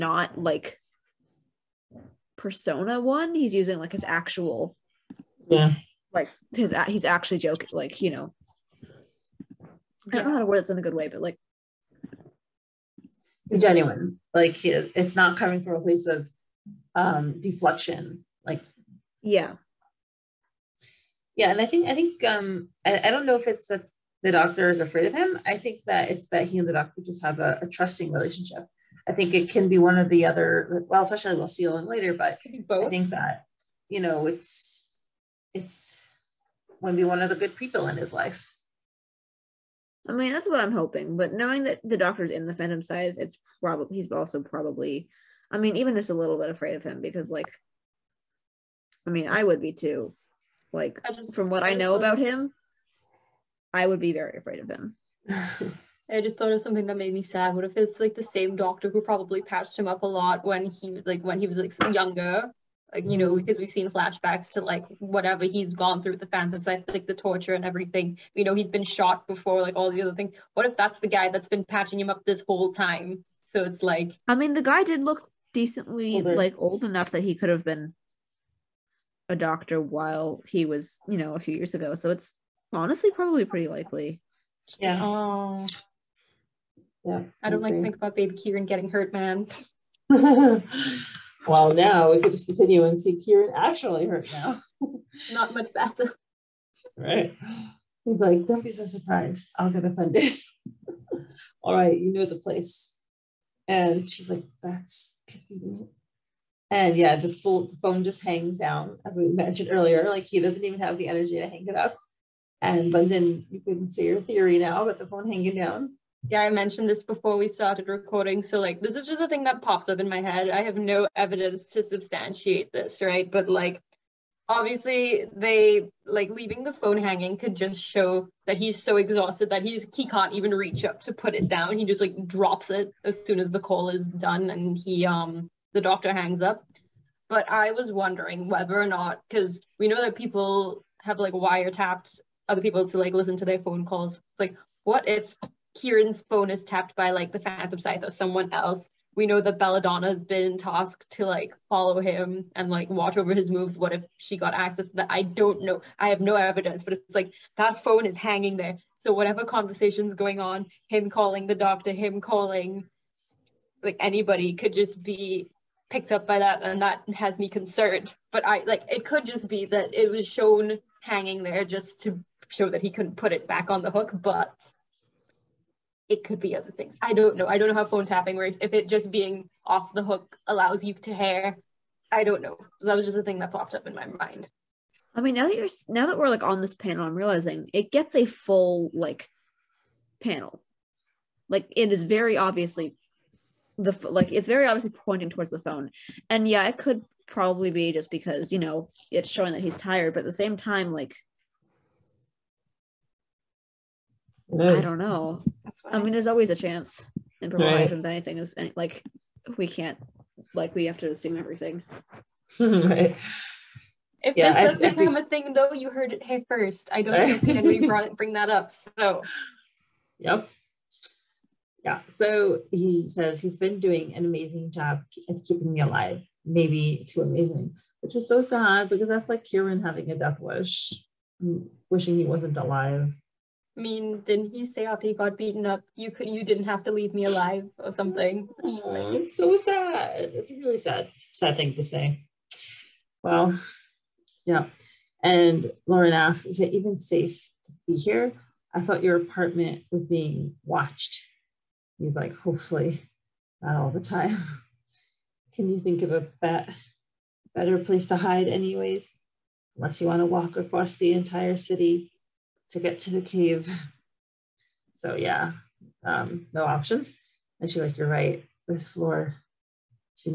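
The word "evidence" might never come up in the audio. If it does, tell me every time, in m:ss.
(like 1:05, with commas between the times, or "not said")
2:01, 2:36.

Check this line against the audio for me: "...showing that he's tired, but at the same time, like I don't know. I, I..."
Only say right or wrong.
right.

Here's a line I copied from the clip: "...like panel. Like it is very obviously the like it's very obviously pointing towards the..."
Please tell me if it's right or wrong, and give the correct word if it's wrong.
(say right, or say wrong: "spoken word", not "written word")
right.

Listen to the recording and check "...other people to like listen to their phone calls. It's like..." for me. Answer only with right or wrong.
right.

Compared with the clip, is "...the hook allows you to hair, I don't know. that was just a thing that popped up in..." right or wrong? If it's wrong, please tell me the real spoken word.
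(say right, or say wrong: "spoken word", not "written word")
right.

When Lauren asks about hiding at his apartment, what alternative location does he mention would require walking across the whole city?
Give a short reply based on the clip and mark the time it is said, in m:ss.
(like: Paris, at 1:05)
the cave, at 4:23.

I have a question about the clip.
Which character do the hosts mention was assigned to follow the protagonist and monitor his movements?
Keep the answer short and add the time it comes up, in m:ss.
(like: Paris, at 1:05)
Belladonna, at 2:29.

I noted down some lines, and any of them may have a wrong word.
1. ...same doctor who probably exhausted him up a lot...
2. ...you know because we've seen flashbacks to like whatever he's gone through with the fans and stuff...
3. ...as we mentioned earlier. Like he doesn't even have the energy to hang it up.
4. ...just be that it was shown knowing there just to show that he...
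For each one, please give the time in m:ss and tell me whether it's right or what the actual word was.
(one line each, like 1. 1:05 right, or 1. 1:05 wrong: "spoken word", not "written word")
1. 0:58 wrong: "patched", not "exhausted"
2. 1:03 right
3. 1:49 right
4. 2:49 wrong: "hanging", not "knowing".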